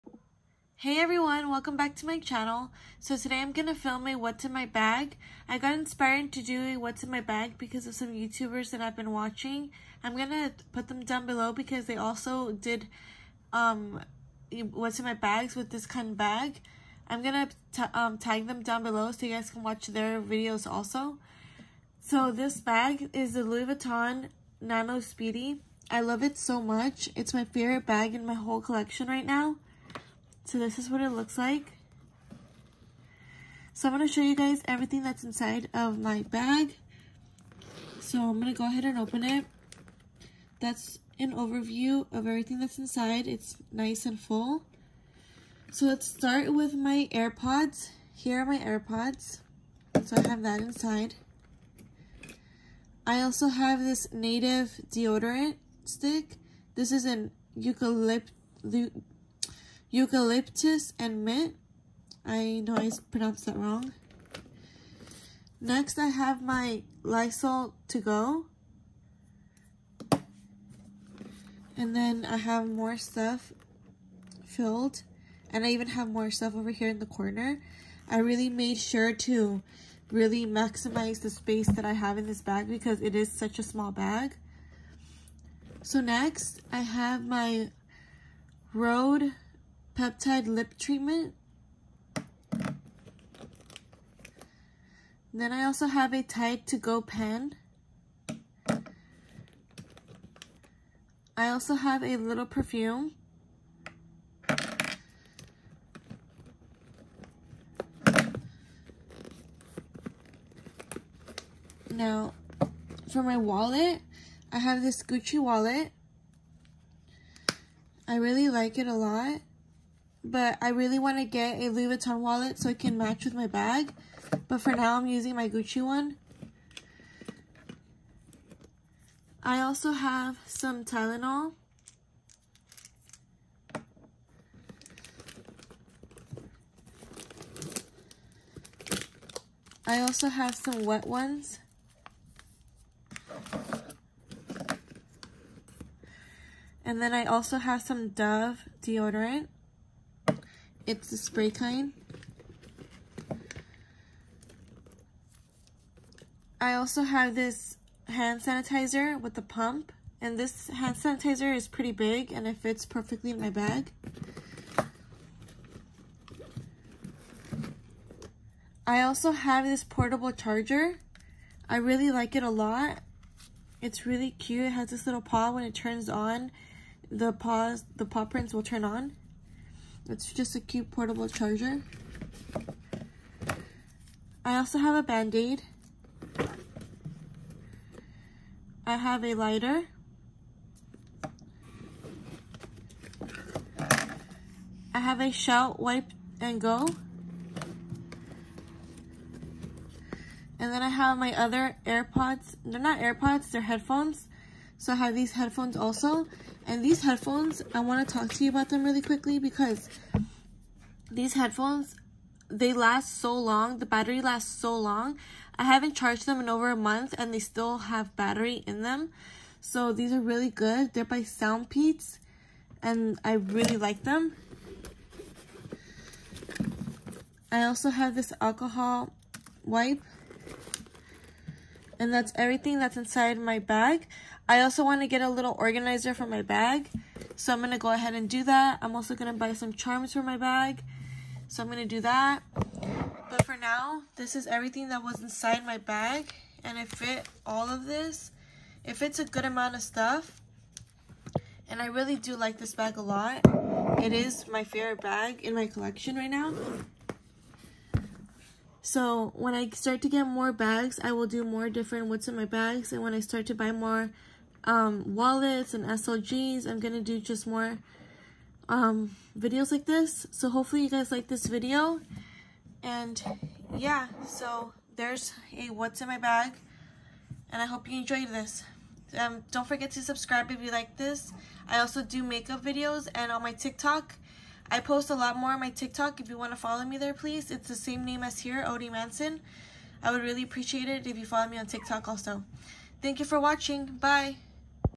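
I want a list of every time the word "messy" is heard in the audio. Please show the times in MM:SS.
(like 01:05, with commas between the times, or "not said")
not said.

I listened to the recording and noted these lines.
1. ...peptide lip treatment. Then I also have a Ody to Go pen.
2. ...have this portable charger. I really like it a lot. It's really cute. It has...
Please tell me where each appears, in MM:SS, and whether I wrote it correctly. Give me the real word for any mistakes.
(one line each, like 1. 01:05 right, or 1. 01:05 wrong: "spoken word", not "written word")
1. 01:30 wrong: "Tide", not "Ody"
2. 02:49 right.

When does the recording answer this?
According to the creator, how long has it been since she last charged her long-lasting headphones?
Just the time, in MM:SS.
03:36.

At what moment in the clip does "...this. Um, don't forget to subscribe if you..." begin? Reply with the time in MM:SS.
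04:38.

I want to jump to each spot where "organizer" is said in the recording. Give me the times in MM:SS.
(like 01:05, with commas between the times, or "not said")
03:55.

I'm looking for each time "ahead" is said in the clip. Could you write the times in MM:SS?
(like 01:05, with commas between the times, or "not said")
00:38, 03:57.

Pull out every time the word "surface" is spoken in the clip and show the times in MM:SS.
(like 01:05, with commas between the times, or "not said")
not said.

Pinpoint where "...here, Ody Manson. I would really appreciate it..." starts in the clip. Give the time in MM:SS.
04:48.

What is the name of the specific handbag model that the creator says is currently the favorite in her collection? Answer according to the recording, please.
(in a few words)
Louis Vuitton Nano Speedy.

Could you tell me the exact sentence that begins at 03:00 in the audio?
It's just a cute portable charger.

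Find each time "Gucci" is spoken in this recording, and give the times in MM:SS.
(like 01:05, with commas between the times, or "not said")
01:55, 02:05.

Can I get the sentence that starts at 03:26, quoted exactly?
And these headphones, I want to talk to you about them really quickly because these headphones, they last so long.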